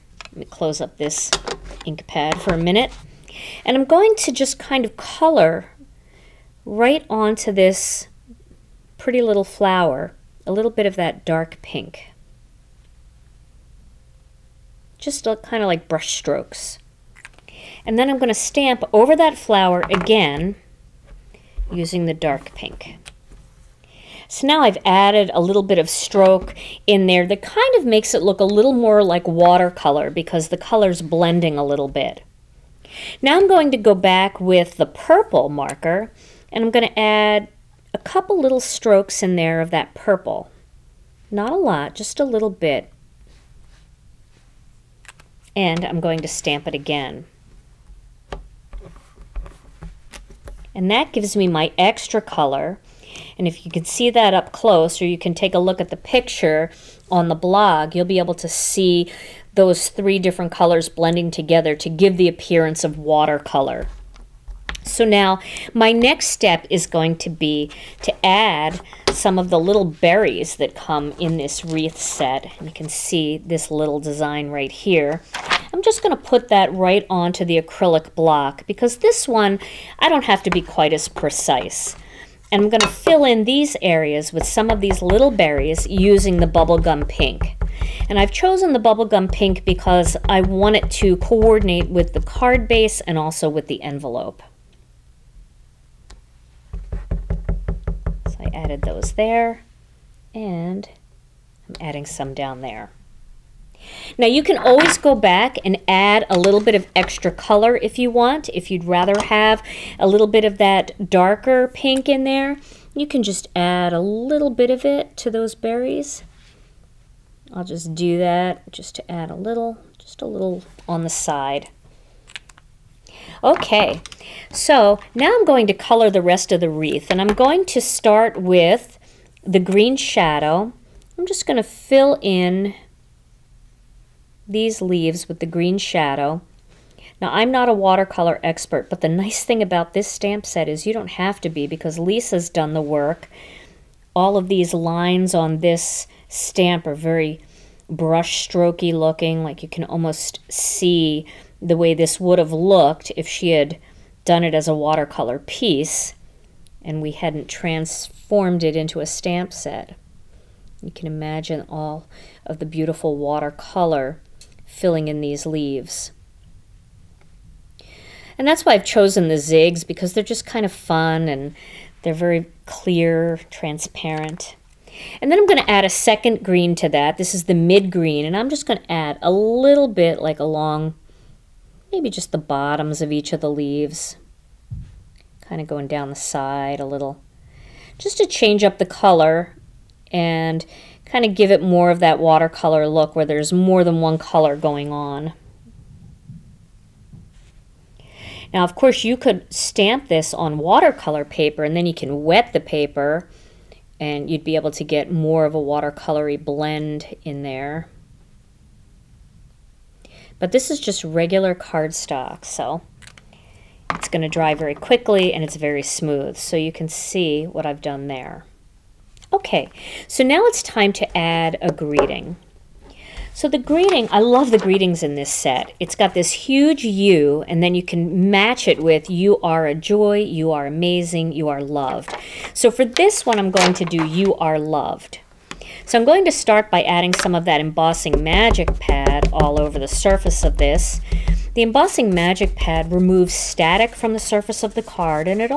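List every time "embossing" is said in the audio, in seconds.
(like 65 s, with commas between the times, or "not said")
237 s, 241 s.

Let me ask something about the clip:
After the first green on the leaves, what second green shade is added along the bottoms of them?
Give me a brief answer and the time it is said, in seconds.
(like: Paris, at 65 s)
mid green, at 177 s.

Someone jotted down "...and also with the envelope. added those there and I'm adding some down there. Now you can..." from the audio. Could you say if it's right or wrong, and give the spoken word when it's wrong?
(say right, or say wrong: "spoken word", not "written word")
right.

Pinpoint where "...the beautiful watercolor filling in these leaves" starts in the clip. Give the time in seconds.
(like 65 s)
162 s.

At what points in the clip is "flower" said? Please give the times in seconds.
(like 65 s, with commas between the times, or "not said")
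9 s, 19 s.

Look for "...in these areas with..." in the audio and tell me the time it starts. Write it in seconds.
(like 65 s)
83 s.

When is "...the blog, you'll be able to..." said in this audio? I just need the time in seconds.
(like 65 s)
57 s.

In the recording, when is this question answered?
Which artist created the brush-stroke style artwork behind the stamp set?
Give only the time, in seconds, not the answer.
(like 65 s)
141 s.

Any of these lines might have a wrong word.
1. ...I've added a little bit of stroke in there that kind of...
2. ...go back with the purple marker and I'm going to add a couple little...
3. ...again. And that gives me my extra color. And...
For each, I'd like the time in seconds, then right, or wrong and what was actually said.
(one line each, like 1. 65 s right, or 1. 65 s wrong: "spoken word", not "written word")
1. 24 s right
2. 33 s right
3. 46 s right.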